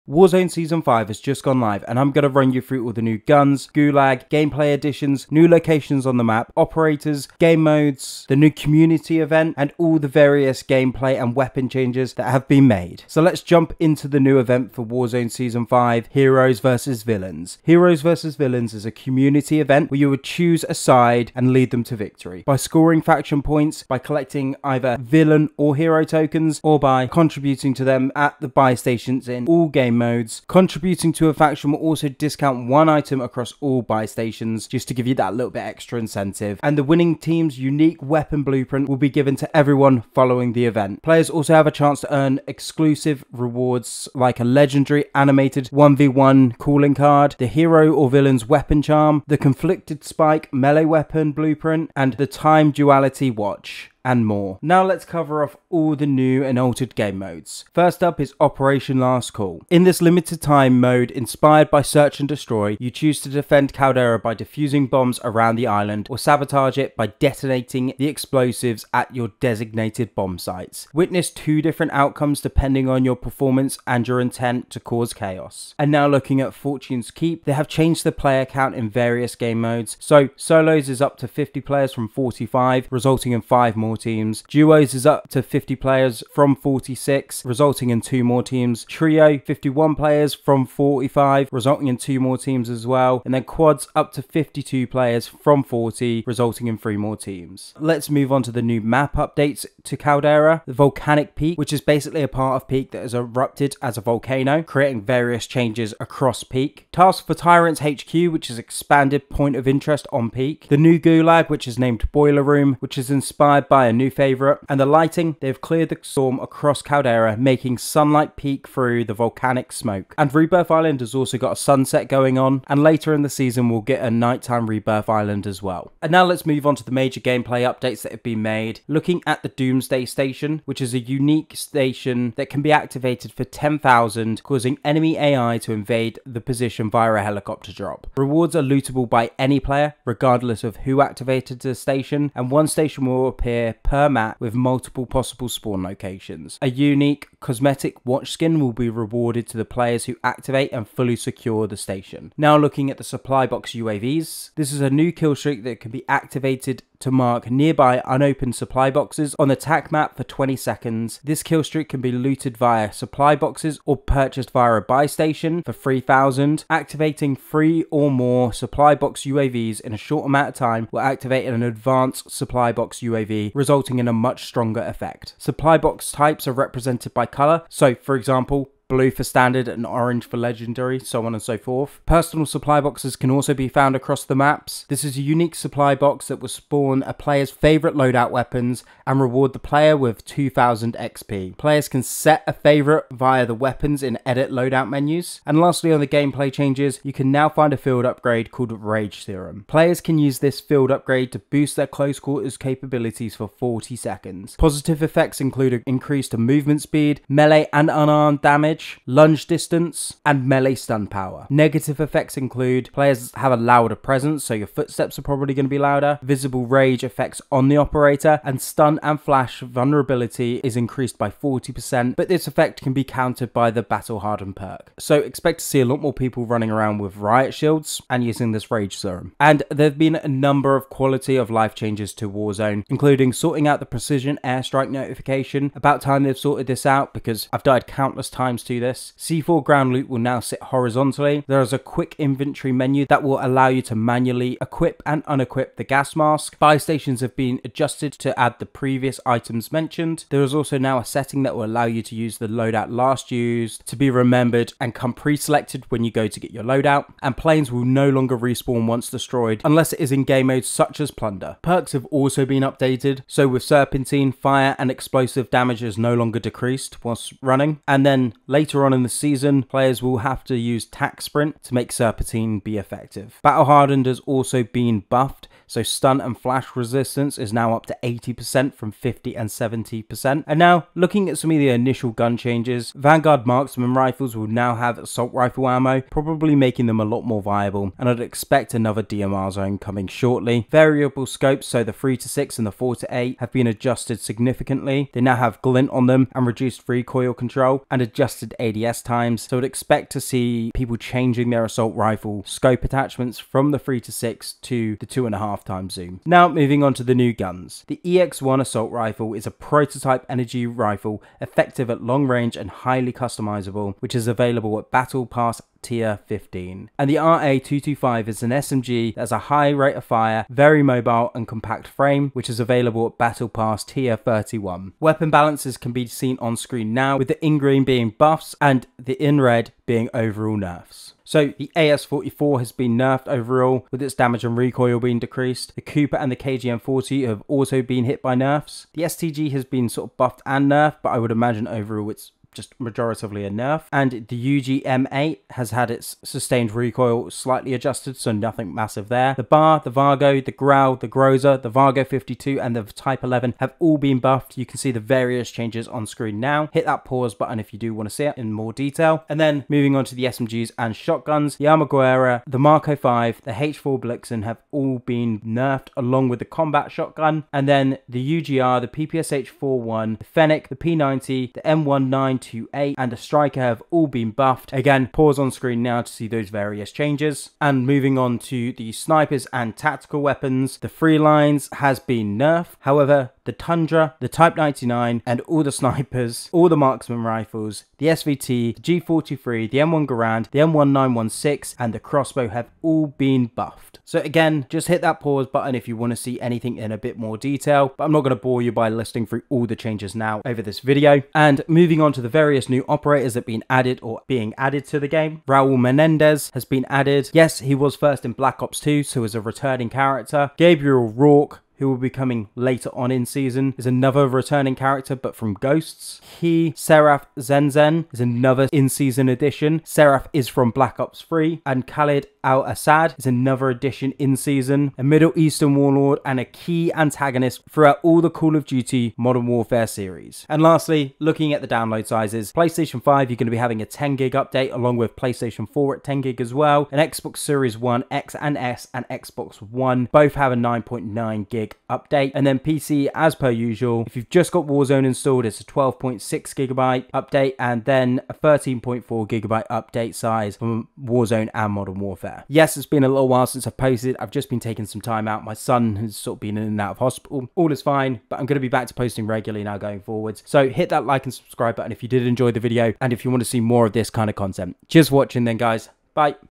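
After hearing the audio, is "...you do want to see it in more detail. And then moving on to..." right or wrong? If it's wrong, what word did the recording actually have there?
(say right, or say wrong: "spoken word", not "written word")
right.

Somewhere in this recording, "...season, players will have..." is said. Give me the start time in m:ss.
4:29.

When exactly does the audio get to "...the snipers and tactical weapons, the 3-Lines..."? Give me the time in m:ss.
6:18.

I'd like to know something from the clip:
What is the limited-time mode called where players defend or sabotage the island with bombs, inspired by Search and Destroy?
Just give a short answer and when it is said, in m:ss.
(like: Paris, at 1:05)
Operation Last Call, at 0:58.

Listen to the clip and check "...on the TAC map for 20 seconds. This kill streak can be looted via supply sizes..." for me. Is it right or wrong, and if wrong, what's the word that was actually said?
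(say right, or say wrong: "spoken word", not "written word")
wrong: "boxes", not "sizes".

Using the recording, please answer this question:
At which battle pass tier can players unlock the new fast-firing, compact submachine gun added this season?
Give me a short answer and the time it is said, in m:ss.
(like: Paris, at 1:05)
31, at 5:23.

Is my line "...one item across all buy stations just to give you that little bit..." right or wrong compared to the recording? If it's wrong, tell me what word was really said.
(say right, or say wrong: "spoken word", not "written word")
right.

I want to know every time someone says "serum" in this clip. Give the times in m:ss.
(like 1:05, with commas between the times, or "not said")
3:19, 3:48.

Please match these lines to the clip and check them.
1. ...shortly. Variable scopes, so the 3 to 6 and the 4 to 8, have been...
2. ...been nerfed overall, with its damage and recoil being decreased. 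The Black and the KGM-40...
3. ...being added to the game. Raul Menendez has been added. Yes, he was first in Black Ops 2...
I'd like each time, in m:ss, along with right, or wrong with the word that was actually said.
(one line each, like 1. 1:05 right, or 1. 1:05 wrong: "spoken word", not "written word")
1. 4:50 right
2. 5:32 wrong: "Cooper", not "Black"
3. 6:44 right.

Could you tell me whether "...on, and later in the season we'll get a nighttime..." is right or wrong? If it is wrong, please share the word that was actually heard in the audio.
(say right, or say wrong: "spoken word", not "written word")
right.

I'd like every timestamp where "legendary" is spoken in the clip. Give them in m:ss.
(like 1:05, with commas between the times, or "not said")
0:44, 3:00.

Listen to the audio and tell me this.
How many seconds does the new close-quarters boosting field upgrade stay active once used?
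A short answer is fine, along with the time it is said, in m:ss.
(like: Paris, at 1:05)
40, at 3:23.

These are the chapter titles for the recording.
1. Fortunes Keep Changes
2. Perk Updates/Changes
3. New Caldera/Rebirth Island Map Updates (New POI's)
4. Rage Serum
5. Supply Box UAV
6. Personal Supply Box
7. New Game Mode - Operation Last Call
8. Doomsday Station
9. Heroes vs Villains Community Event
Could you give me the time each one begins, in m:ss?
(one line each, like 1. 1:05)
1. 1:16
2. 4:21
3. 1:40
4. 3:18
5. 2:32
6. 3:02
7. 0:57
8. 2:08
9. 0:16.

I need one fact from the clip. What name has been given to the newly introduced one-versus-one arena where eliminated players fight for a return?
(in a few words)
Boiler Room.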